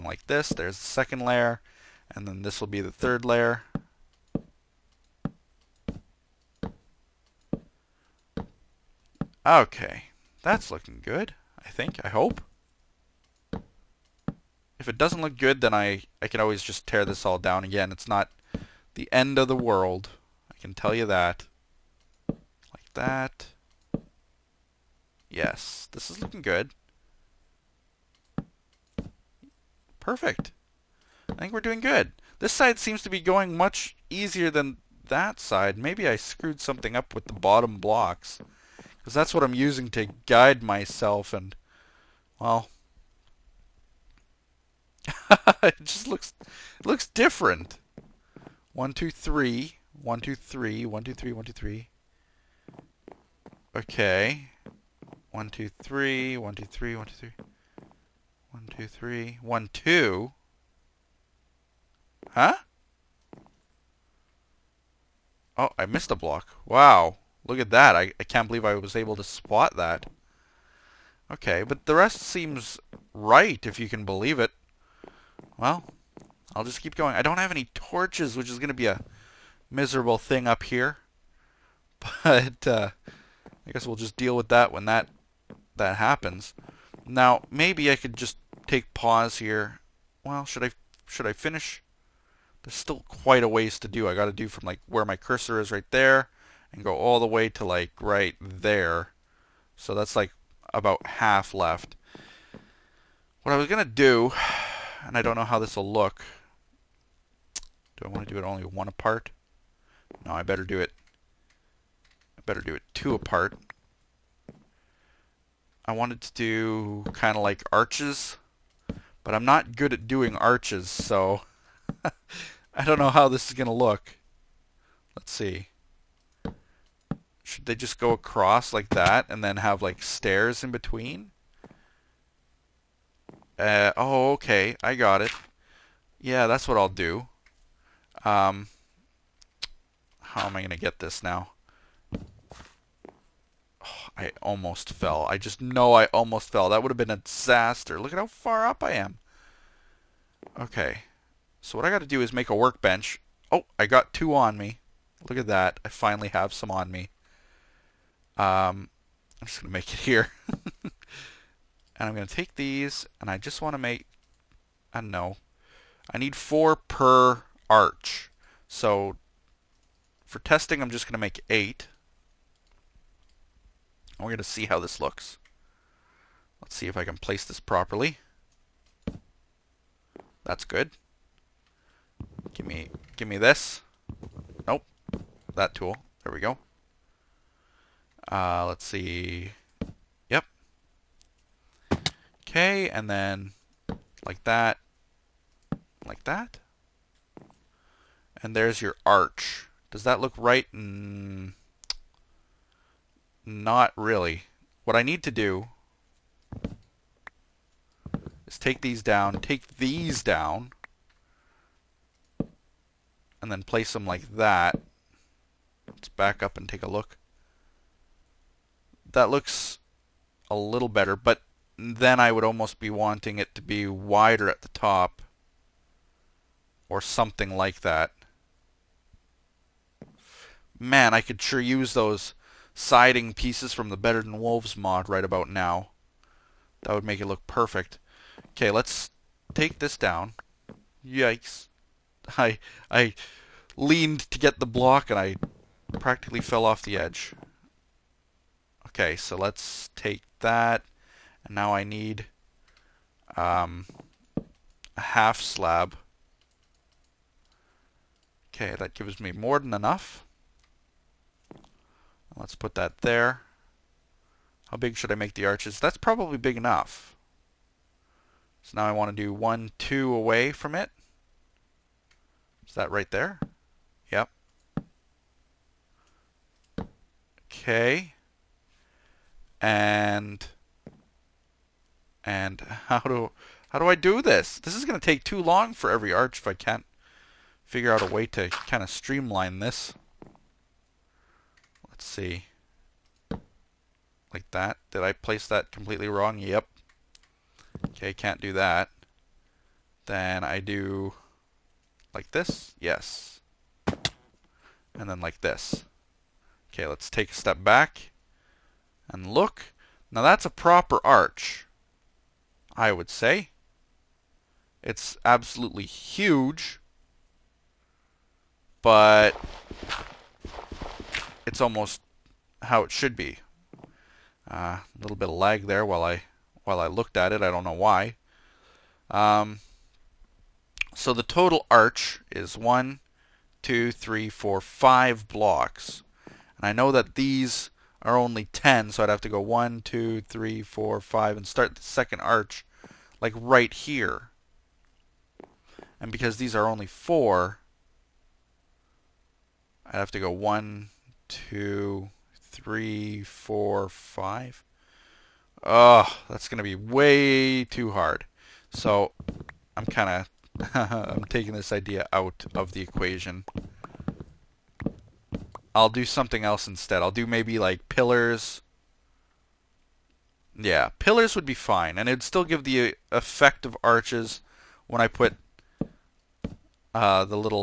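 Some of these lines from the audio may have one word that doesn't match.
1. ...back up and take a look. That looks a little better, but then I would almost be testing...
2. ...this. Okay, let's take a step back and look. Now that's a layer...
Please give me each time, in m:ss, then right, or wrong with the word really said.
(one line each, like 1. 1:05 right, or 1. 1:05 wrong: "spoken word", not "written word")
1. 3:36 wrong: "wanting", not "testing"
2. 5:05 wrong: "proper", not "layer".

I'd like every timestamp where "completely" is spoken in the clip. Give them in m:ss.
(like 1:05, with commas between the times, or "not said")
4:55.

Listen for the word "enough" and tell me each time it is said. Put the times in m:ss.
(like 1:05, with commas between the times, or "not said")
4:19, 4:26.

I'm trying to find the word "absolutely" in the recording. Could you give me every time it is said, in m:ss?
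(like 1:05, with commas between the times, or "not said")
5:15.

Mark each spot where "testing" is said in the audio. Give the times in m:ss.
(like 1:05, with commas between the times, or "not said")
2:50.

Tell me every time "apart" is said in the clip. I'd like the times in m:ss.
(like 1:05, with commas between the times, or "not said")
1:48, 1:53.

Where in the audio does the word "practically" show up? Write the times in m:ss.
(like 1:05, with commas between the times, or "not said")
4:05.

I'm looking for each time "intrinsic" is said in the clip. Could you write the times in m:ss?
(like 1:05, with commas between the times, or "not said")
not said.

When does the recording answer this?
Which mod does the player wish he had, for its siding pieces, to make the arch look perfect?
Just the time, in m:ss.
3:53.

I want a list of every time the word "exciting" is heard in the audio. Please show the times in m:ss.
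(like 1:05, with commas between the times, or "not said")
not said.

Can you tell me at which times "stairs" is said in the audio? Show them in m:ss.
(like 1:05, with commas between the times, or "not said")
2:10.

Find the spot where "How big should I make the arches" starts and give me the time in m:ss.
4:24.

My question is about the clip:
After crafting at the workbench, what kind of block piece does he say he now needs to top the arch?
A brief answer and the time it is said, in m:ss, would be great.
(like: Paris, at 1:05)
half slab, at 4:15.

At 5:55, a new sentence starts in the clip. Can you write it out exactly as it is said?
Oh, that's going to be way too hard.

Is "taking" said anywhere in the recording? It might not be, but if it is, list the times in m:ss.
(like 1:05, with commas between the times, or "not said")
6:01.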